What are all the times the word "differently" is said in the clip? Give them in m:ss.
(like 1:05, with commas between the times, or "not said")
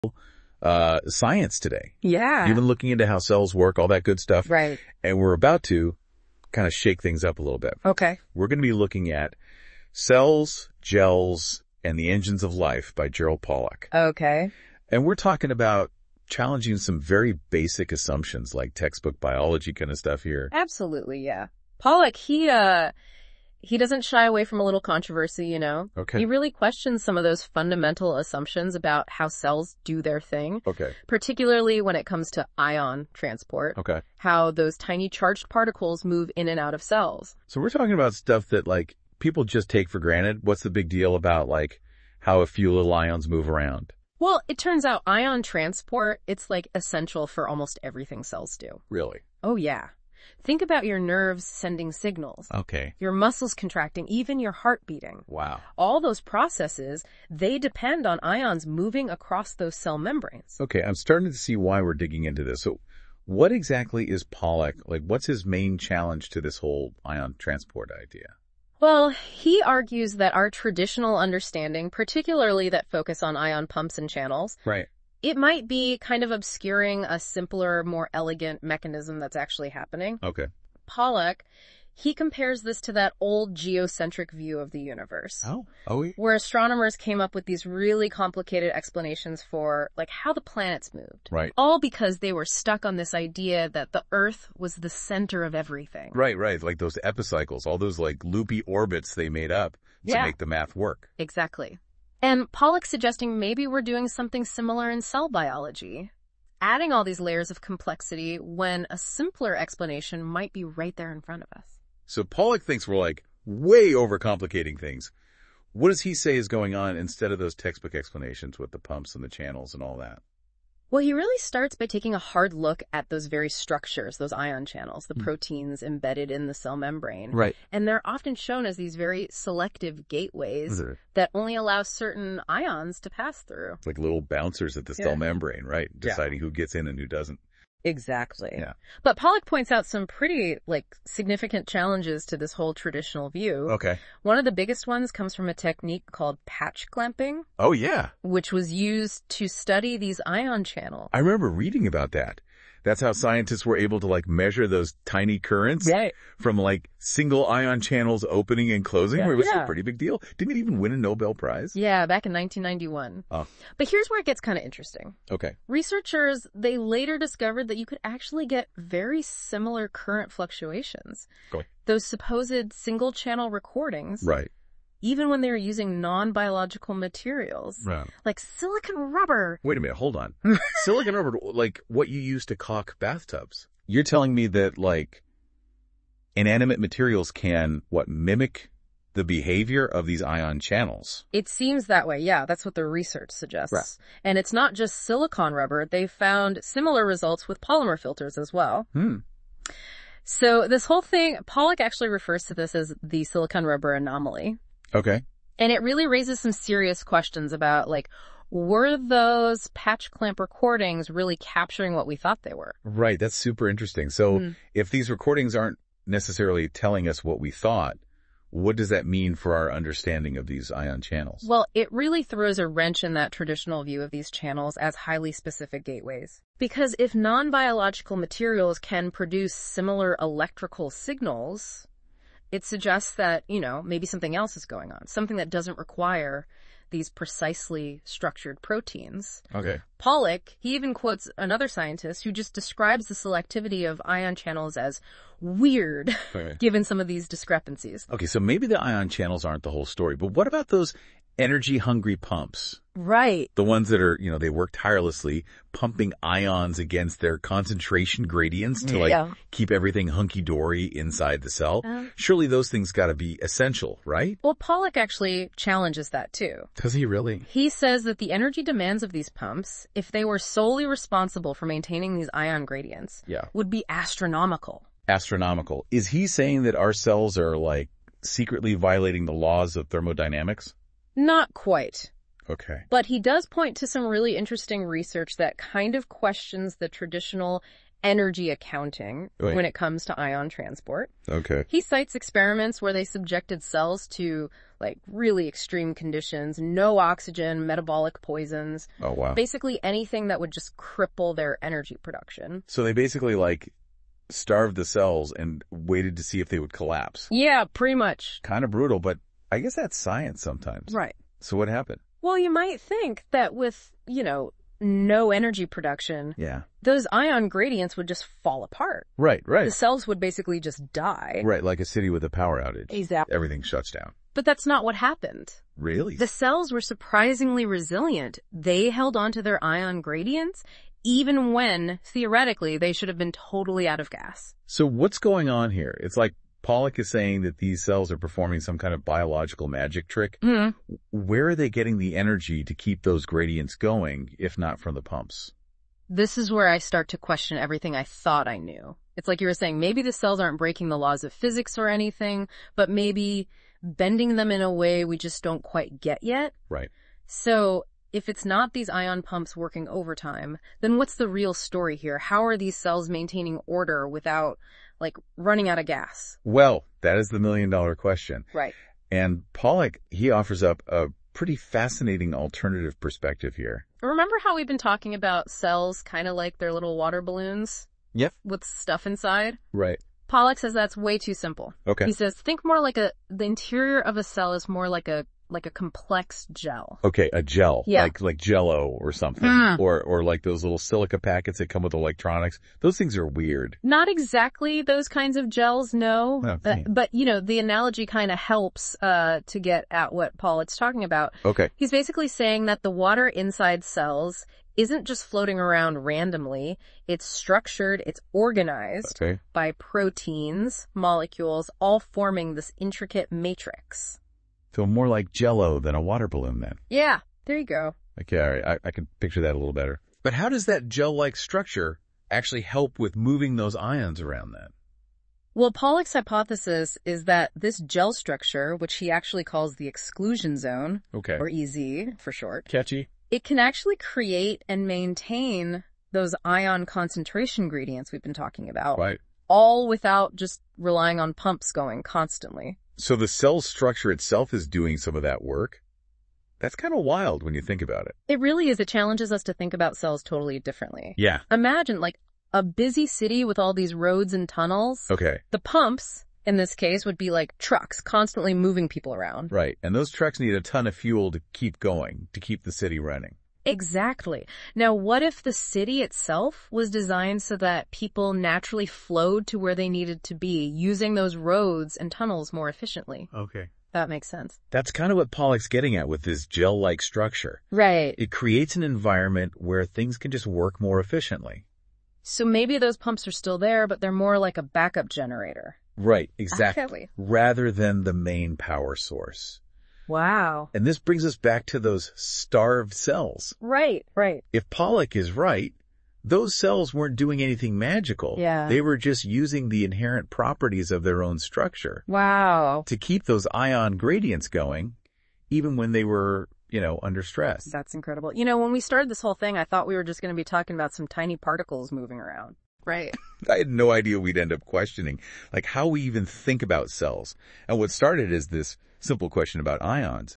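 7:30.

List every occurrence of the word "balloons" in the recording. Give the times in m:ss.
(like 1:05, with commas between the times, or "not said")
6:17, 6:56.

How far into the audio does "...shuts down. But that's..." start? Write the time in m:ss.
5:23.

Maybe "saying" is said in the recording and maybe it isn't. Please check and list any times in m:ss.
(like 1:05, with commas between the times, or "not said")
4:36, 5:37, 5:49, 6:42.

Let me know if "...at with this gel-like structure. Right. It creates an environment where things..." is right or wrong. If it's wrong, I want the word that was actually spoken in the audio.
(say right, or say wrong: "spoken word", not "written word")
right.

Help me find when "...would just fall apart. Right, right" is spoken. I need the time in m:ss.
5:17.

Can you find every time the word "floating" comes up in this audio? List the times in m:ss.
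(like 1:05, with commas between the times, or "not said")
6:45.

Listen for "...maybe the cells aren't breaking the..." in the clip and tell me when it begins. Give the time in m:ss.
5:49.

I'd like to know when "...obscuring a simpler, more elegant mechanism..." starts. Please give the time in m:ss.
1:16.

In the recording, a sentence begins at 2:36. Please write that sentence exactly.
from like single ion channels opening and closing, yeah.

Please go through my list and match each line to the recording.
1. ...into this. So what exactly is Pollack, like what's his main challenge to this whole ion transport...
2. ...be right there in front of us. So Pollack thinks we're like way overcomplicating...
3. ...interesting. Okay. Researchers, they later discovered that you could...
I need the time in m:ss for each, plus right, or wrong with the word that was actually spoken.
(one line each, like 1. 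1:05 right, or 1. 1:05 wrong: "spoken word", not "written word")
1. 1:02 right
2. 1:50 right
3. 2:44 right.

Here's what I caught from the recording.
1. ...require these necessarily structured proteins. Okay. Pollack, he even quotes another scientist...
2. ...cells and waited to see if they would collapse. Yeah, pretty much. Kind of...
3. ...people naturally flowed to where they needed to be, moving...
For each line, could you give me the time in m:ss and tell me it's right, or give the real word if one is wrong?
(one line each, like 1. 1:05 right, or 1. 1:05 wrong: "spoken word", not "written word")
1. 3:55 wrong: "precisely", not "necessarily"
2. 5:04 right
3. 7:47 wrong: "using", not "moving".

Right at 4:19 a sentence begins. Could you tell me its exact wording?
keep everything hunky dory inside the cell.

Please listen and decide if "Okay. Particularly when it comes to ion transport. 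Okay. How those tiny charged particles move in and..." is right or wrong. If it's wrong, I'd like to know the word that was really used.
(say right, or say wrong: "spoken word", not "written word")
right.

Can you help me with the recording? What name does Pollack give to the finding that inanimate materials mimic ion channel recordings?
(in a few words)
Silicon rubber anomaly.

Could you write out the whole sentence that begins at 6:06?
Well, that is the million dollar question.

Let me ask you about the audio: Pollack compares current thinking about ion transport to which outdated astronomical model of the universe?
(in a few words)
Geocentric view.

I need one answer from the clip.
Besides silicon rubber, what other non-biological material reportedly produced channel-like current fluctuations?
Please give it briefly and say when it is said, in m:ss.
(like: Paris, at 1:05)
Polymer filters, at 3:17.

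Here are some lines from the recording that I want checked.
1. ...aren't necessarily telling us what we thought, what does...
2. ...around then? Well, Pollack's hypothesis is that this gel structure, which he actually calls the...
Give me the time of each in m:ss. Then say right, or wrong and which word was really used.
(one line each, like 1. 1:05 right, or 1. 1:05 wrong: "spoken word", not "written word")
1. 3:35 right
2. 7:04 right.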